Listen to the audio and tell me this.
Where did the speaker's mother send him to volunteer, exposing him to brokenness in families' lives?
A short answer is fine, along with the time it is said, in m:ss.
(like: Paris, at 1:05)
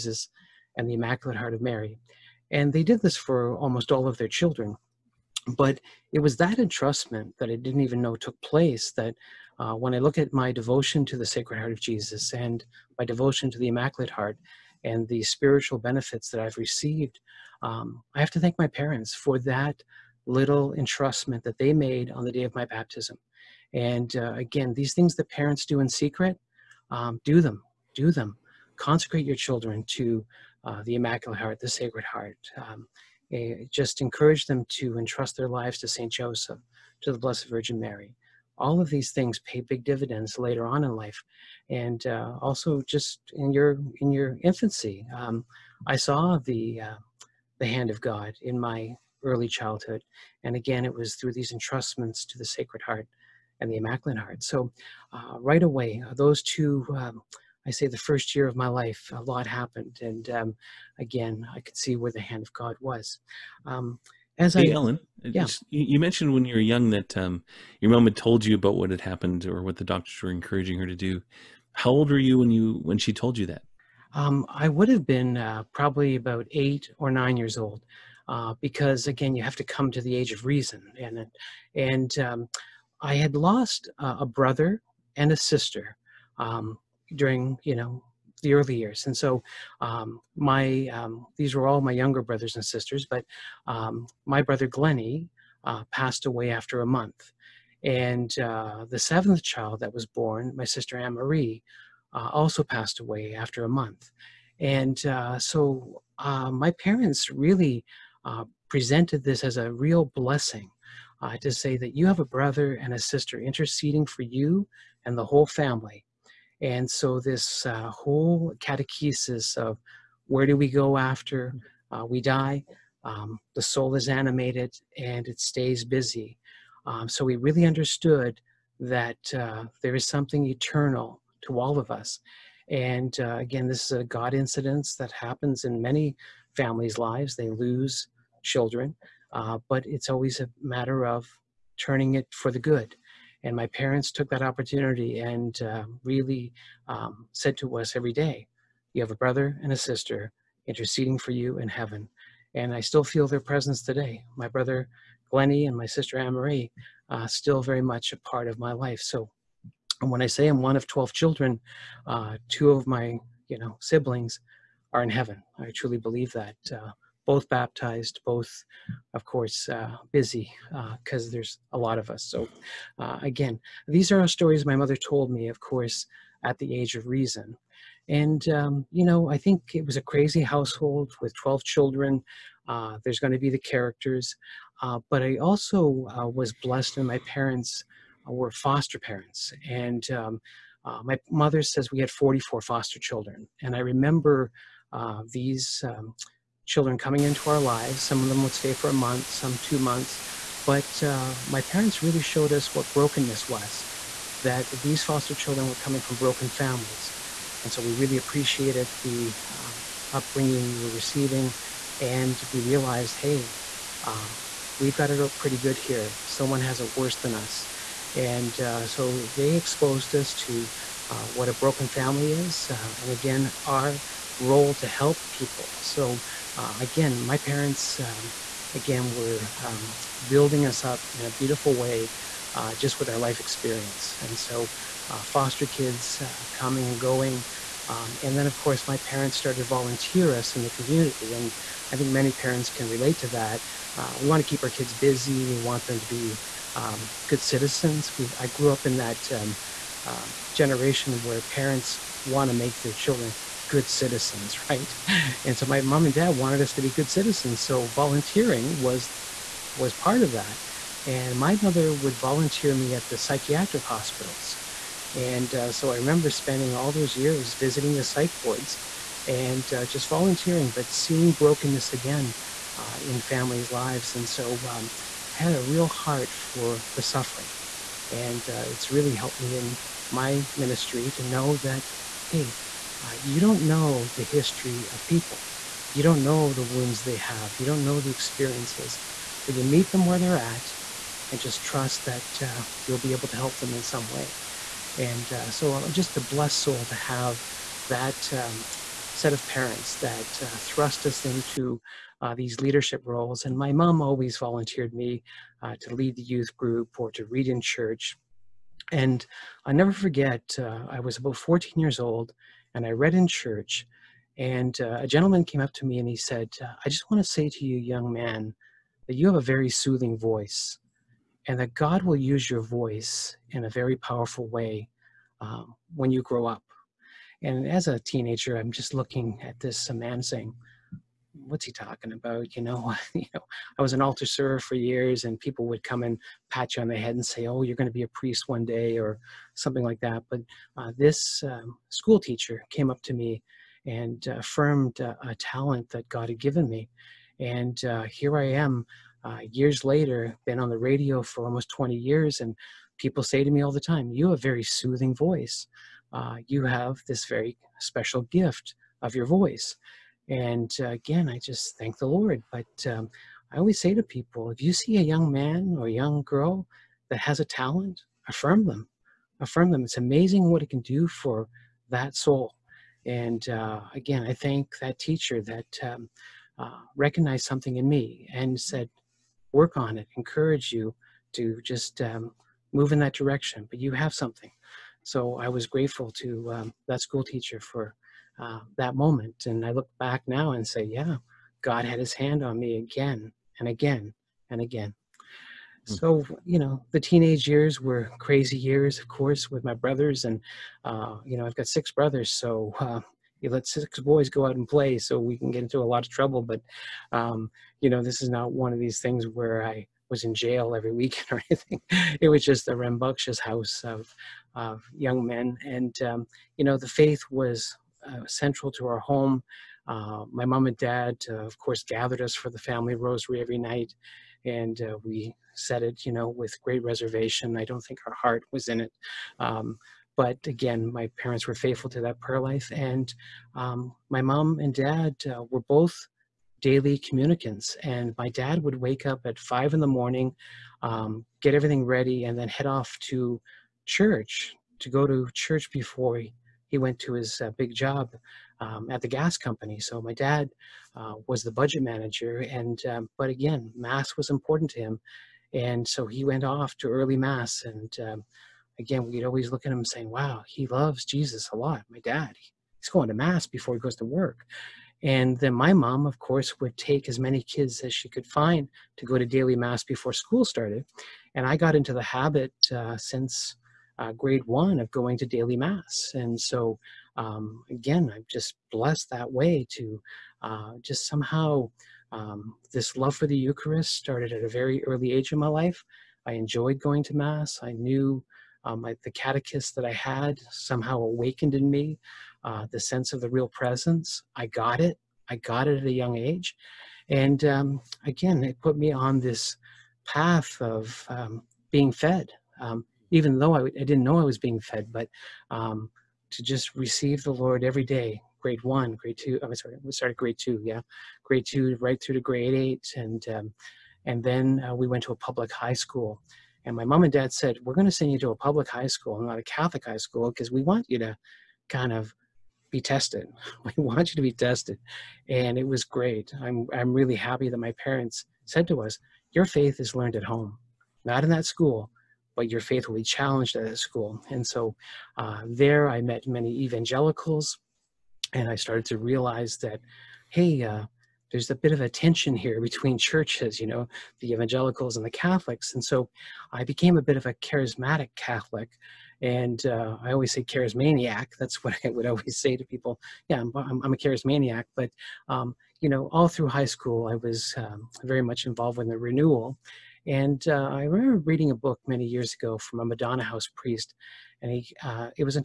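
psychiatric hospitals, at 4:23.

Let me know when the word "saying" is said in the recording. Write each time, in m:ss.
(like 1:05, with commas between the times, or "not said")
5:30, 7:39.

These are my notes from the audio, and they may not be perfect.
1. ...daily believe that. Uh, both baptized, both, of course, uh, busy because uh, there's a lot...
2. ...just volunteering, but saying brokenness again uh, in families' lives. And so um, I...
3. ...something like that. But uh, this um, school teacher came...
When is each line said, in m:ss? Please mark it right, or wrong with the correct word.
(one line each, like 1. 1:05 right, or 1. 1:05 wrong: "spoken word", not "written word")
1. 2:45 wrong: "truly", not "daily"
2. 4:29 wrong: "seeing", not "saying"
3. 5:39 right.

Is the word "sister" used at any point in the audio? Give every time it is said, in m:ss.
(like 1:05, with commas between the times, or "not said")
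1:25, 1:32, 1:40, 1:52, 2:29, 2:35.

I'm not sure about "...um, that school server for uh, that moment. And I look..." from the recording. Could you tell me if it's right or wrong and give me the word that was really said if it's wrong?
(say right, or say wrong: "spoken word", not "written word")
wrong: "teacher", not "server".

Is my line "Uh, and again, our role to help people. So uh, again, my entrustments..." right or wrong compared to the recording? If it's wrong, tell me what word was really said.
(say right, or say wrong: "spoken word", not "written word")
wrong: "parents", not "entrustments".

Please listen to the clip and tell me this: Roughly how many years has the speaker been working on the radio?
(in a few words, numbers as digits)
20.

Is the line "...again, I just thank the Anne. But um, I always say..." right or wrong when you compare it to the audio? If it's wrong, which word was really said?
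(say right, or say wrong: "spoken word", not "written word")
wrong: "Lord", not "Anne".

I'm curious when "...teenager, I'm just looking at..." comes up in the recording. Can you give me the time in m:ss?
5:27.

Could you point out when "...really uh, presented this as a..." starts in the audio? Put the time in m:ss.
1:47.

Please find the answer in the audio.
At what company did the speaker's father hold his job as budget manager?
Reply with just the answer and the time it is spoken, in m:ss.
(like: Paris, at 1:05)
the gas company, at 7:29.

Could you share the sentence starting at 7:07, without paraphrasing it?
I don't think our heart was in it.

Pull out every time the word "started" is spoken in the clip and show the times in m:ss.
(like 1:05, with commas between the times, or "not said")
3:59, 7:50, 8:03, 8:29, 8:58.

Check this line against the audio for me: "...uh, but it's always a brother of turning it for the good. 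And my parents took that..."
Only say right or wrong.
wrong.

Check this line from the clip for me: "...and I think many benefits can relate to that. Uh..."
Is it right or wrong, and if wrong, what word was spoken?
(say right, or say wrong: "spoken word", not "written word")
wrong: "parents", not "benefits".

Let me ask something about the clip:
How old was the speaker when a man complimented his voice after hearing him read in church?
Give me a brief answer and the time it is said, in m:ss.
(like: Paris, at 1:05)
14, at 5:11.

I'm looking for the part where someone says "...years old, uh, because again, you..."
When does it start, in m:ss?
1:17.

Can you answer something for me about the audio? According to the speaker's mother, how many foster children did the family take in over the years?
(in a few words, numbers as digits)
44.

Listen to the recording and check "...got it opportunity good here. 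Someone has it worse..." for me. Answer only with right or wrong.
wrong.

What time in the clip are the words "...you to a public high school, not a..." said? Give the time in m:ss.
8:38.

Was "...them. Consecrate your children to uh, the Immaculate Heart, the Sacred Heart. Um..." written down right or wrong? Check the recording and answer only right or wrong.
right.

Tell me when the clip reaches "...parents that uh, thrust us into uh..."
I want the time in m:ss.
4:59.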